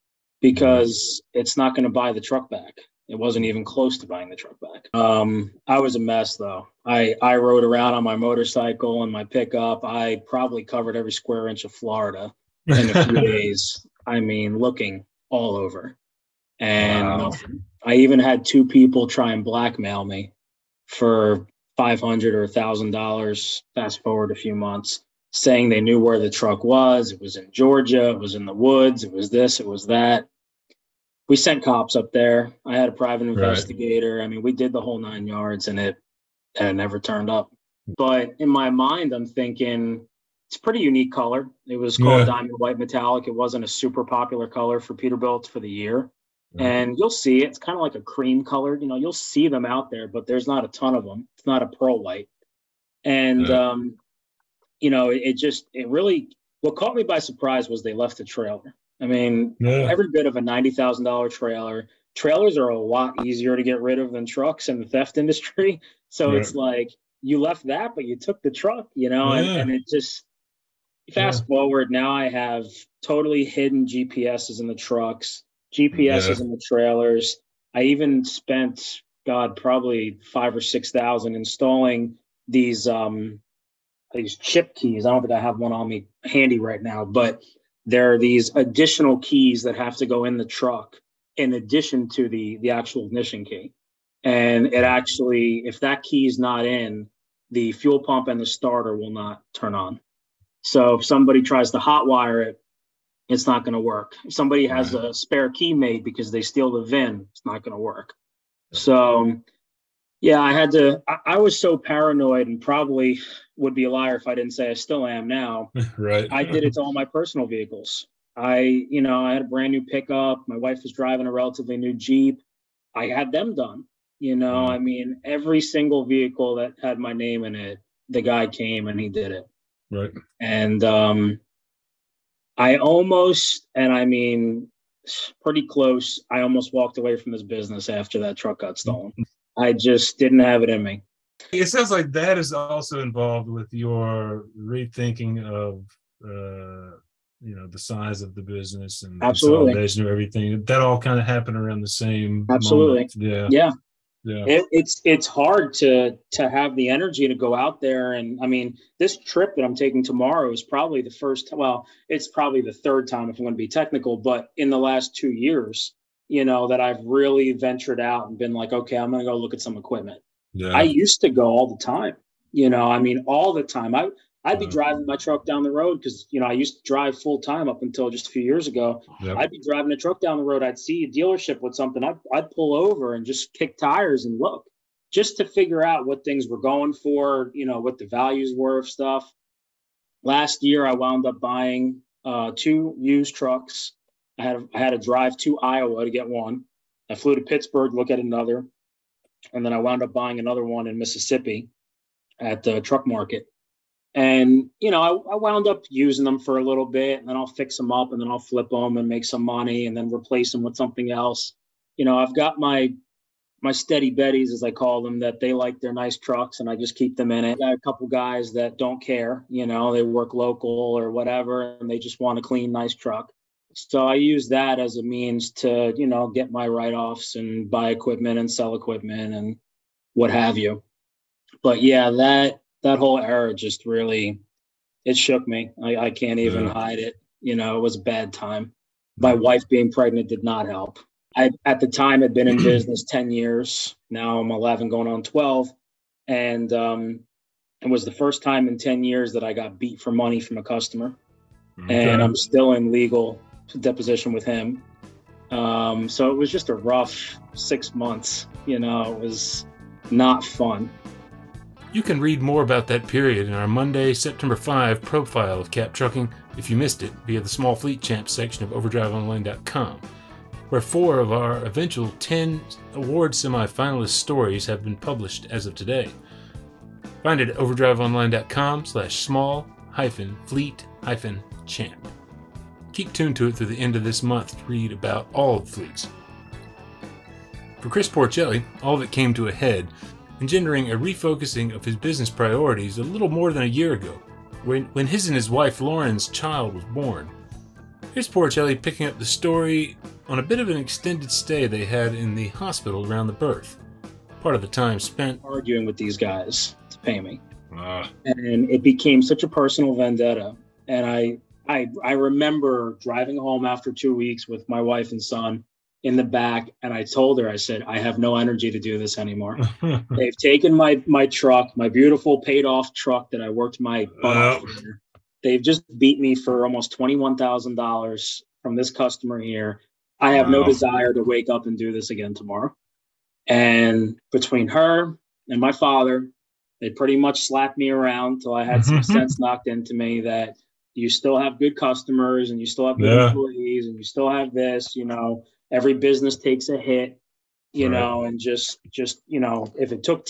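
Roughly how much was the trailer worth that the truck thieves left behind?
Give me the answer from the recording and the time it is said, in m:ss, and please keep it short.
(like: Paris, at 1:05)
$90,000, at 1:00.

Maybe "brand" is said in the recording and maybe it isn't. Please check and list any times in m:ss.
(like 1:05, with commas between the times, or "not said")
1:59.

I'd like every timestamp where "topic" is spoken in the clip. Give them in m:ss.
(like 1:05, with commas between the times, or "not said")
not said.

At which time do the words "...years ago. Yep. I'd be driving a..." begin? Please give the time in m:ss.
2:58.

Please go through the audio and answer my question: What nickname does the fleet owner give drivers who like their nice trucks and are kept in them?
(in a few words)
steady betties.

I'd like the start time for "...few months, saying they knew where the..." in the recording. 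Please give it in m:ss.
0:24.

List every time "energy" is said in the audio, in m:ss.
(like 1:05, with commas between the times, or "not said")
2:36, 5:18.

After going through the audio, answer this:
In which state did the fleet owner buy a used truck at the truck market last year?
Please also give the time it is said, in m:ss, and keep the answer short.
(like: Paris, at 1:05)
Mississippi, at 3:20.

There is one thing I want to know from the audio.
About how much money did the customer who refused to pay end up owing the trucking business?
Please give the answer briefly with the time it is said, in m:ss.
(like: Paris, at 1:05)
$21,000, at 5:26.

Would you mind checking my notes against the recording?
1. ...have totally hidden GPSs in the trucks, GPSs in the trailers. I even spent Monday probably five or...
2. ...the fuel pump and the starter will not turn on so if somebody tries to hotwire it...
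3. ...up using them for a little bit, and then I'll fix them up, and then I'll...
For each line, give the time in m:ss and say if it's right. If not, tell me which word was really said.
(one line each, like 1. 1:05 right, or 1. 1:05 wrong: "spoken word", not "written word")
1. 1:12 wrong: "God", not "Monday"
2. 1:37 right
3. 3:25 right.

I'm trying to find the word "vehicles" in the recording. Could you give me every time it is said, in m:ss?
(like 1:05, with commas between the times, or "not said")
1:57, 2:06.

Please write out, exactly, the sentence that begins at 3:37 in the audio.
I got a couple guys that don't care.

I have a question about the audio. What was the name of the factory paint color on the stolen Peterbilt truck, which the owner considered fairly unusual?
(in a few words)
Diamond White Metallic.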